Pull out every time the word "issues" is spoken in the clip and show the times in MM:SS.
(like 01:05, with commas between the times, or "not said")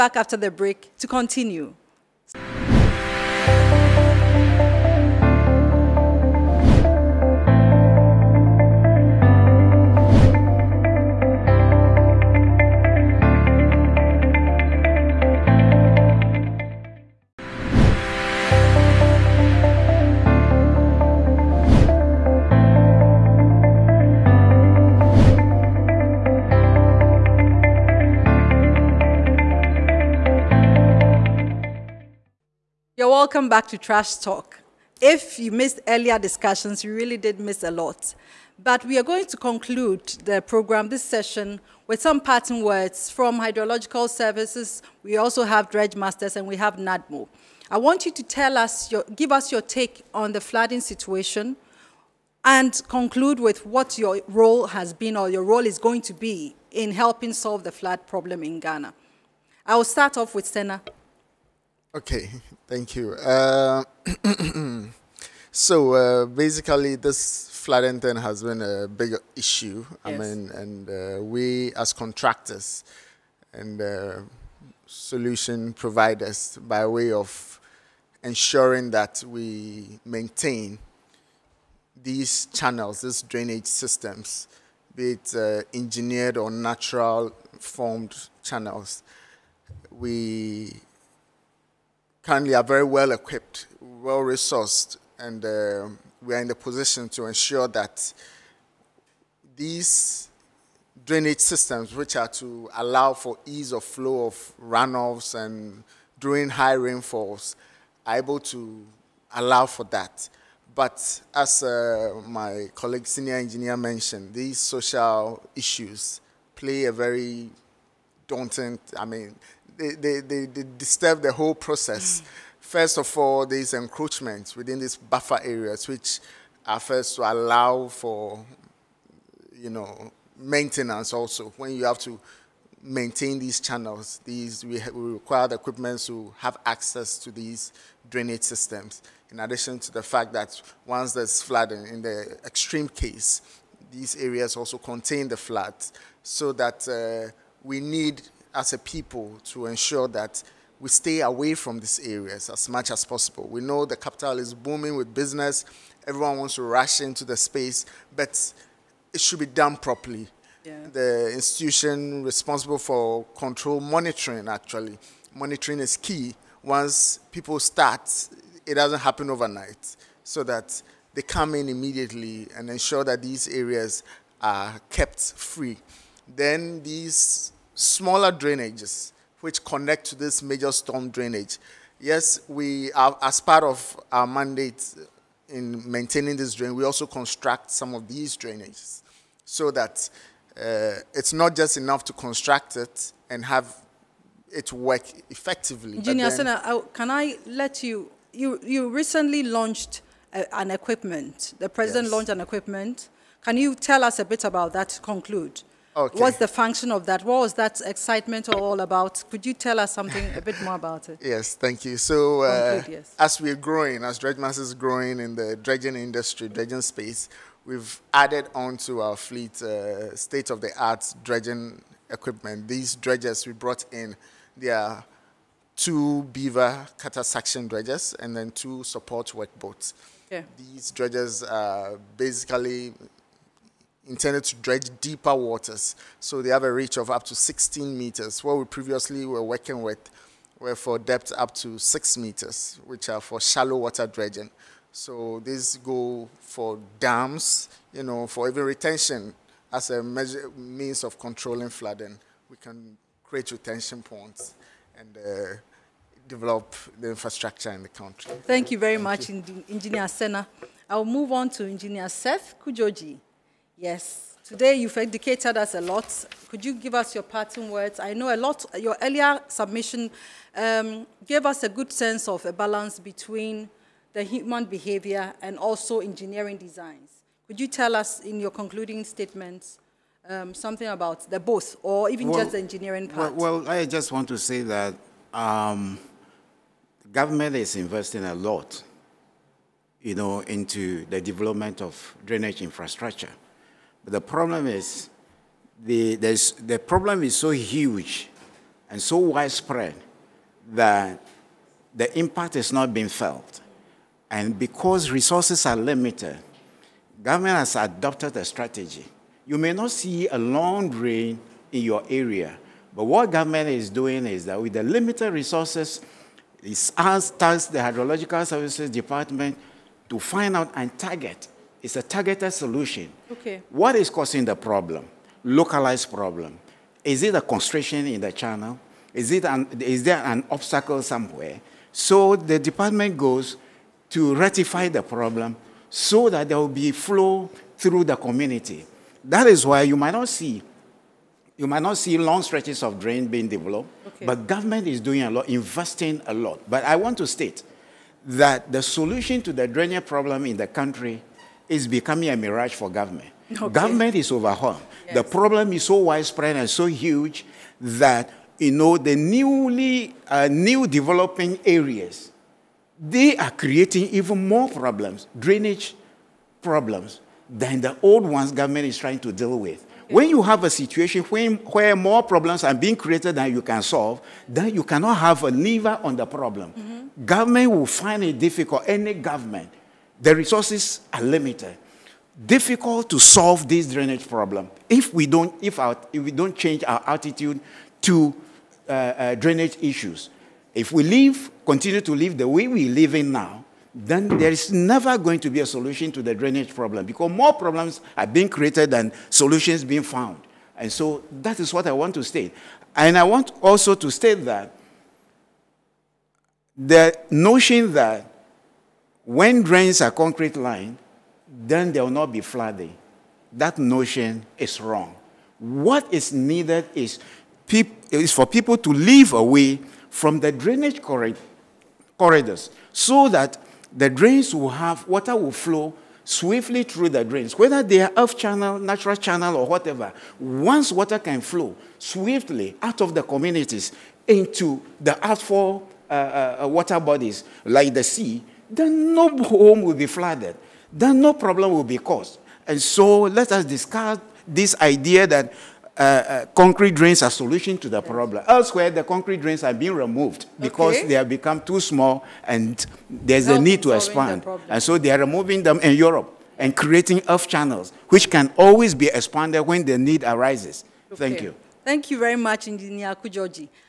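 01:09, 01:55, 06:29.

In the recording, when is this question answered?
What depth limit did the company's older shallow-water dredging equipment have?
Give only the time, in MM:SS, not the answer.
04:01.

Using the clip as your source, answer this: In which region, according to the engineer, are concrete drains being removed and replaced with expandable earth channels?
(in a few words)
Europe.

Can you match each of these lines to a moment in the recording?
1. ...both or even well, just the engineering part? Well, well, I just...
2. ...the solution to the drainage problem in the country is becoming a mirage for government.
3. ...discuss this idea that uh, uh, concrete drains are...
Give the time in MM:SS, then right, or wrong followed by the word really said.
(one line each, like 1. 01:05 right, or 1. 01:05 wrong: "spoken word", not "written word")
1. 04:41 right
2. 05:48 right
3. 07:23 right.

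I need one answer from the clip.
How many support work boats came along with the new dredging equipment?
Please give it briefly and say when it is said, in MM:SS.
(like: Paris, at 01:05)
2, at 03:48.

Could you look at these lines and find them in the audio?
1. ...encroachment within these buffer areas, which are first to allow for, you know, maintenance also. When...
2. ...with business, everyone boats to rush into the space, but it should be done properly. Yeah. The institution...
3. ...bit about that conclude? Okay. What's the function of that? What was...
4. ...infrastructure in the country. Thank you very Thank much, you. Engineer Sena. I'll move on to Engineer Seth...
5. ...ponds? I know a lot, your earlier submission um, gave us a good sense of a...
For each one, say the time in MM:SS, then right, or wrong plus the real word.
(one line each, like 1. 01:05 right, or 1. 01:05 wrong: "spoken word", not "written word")
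1. 02:03 right
2. 02:34 wrong: "wants", not "boats"
3. 03:24 right
4. 04:17 right
5. 04:27 wrong: "words", not "ponds".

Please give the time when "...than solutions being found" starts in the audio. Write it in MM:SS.
06:38.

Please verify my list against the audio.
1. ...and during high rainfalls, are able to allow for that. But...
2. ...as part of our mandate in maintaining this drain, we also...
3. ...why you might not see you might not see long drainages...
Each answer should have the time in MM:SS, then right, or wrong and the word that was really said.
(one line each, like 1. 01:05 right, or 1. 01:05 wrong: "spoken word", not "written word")
1. 01:45 right
2. 03:03 right
3. 05:39 wrong: "stretches", not "drainages".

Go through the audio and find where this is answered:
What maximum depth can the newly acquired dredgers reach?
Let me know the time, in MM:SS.
03:57.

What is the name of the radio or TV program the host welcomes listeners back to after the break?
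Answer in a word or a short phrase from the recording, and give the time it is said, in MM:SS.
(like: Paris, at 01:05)
Trash Talk, at 00:33.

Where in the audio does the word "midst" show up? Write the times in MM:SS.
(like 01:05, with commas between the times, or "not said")
not said.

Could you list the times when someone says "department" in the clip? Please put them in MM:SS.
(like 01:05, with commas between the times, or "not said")
05:18, 05:32.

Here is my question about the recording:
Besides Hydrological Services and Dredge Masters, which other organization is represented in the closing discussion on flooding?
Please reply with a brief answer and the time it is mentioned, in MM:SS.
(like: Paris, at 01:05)
NADMO, at 00:46.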